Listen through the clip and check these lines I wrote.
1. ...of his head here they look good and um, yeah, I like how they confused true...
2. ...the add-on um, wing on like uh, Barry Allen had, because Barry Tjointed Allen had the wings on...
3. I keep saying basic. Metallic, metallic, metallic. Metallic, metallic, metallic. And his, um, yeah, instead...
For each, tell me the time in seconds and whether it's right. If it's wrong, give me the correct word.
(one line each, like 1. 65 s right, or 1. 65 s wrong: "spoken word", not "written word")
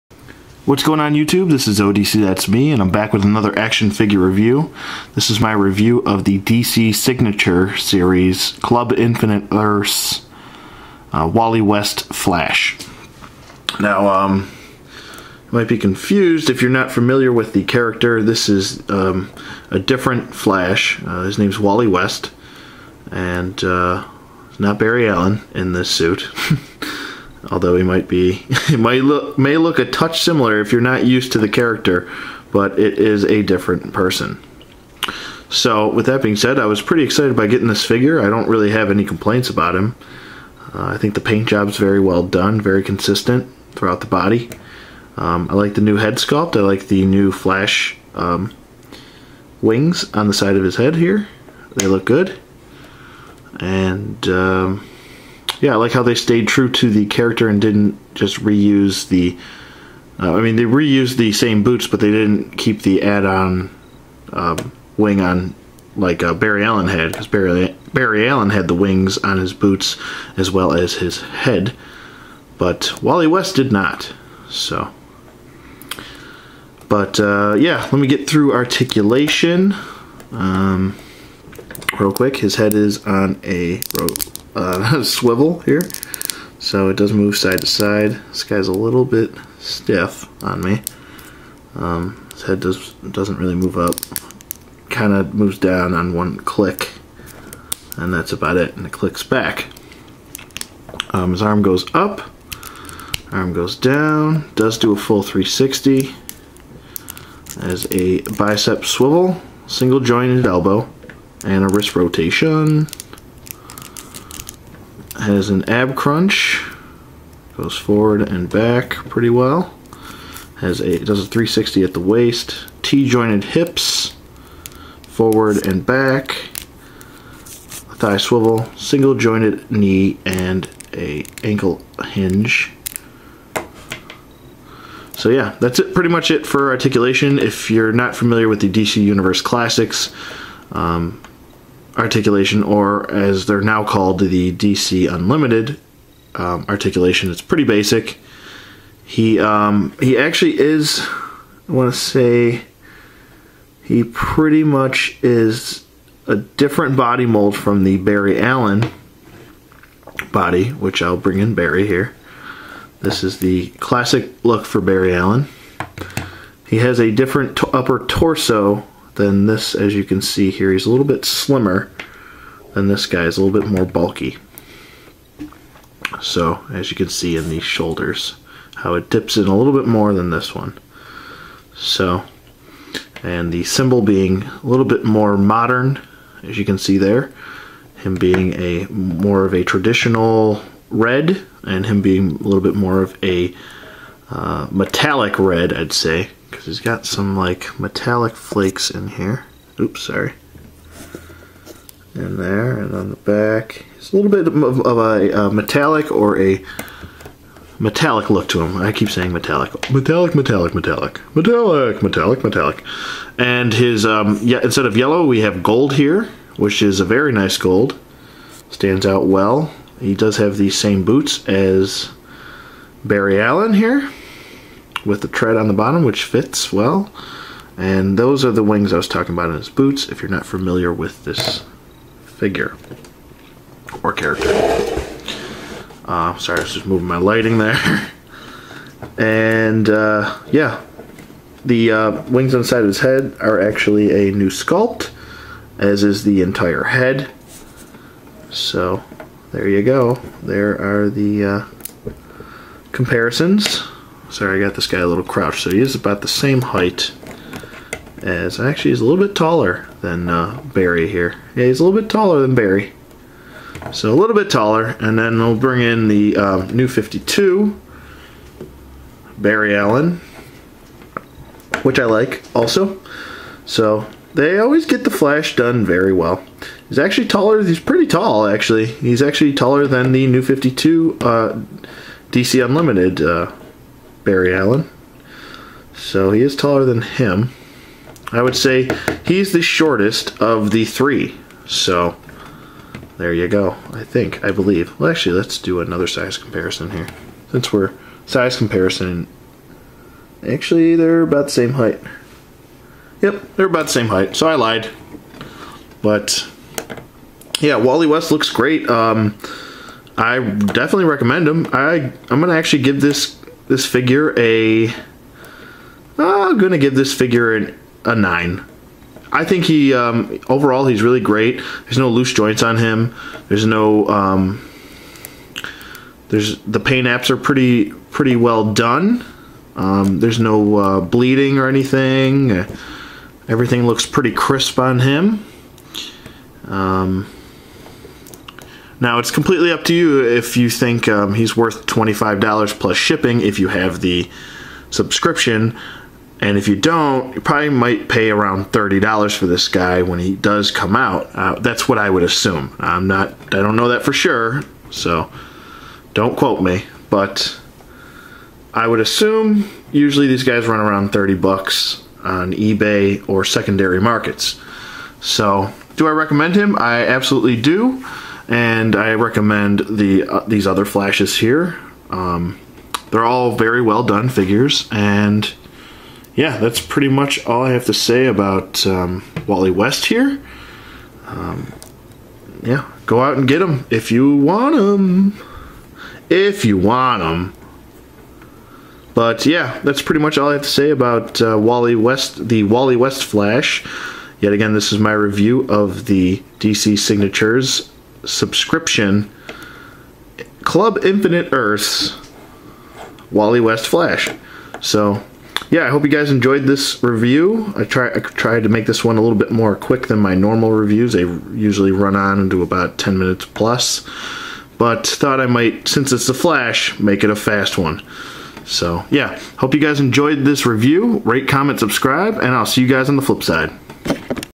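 1. 50 s wrong: "stayed", not "confused"
2. 62 s wrong: "Barry", not "Tjointed"
3. 208 s wrong: "metallic", not "basic".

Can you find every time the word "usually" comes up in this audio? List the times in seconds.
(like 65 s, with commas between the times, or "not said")
359 s, 411 s.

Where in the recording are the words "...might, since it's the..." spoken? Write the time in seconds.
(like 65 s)
415 s.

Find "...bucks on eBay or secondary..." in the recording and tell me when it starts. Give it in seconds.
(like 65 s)
361 s.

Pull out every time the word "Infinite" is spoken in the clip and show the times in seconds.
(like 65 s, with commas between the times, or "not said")
8 s, 401 s.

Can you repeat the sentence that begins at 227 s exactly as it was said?
And those are the wings I was talking about in his boots, if you're not familiar with this figure or character.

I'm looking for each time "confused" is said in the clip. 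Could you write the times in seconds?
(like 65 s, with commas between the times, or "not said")
15 s.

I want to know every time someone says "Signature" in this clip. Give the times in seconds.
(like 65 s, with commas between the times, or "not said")
6 s, 396 s.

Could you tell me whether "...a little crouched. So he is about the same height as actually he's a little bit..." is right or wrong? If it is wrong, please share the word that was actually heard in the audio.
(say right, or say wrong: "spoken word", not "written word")
right.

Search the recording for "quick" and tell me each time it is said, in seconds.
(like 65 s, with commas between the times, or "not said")
82 s, 409 s.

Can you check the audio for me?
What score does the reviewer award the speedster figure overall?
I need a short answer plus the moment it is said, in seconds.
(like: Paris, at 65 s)
9, at 318 s.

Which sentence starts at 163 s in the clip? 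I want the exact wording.
This is the classic look for Barry Allen.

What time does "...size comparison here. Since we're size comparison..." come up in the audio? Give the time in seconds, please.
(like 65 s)
296 s.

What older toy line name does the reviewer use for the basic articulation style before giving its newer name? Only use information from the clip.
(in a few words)
DC Universe Classics.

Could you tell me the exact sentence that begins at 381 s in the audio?
Um, yeah, go out and get them if you want them.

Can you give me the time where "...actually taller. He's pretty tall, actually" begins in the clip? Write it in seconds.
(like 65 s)
276 s.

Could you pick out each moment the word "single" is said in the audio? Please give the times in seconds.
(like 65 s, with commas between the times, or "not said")
109 s, 128 s.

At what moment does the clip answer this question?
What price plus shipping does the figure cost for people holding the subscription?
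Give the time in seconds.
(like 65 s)
341 s.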